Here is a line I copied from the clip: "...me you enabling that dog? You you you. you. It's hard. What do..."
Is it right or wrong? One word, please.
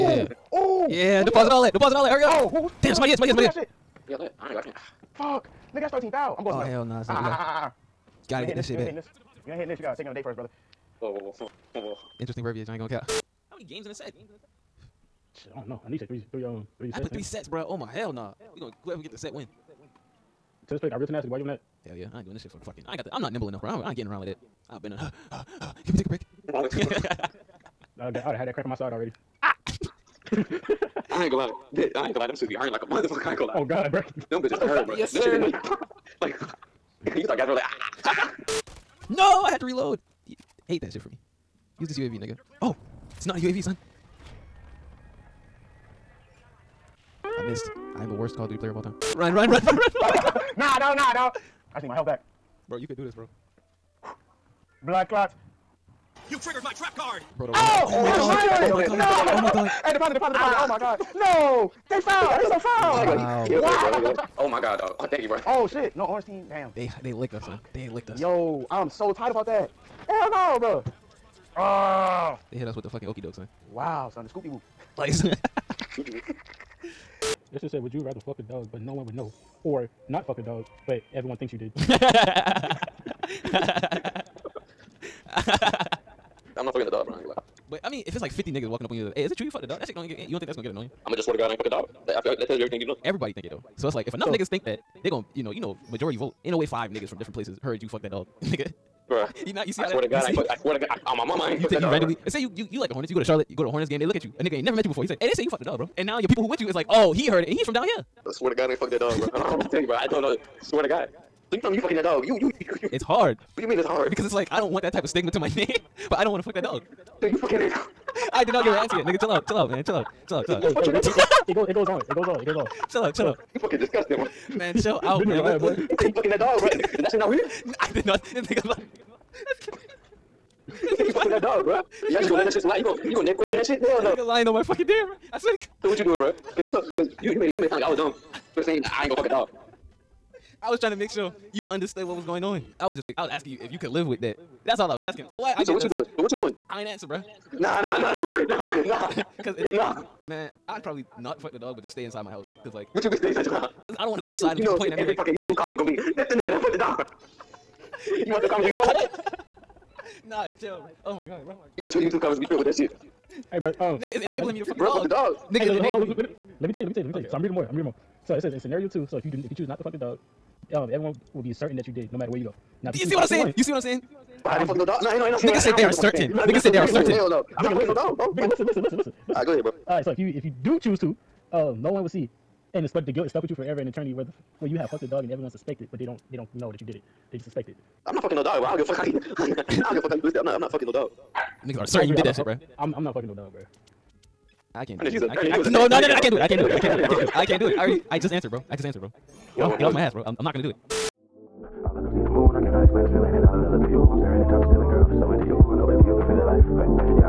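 wrong.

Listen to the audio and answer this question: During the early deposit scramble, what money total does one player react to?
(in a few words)
13,000.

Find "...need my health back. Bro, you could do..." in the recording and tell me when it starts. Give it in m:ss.
0:51.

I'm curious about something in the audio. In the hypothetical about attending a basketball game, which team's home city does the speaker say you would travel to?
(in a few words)
Charlotte.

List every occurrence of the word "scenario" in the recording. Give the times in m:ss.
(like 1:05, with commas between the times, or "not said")
2:48.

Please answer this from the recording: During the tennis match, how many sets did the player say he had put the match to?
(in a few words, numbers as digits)
3.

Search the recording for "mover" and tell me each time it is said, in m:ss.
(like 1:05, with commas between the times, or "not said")
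not said.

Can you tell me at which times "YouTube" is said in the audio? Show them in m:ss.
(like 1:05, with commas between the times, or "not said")
2:35, 2:41.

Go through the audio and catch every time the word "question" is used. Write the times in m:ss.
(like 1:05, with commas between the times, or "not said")
2:13.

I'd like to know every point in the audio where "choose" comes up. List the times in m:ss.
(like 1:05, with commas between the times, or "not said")
2:49, 3:00.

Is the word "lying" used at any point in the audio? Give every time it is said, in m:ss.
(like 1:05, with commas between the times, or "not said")
2:14.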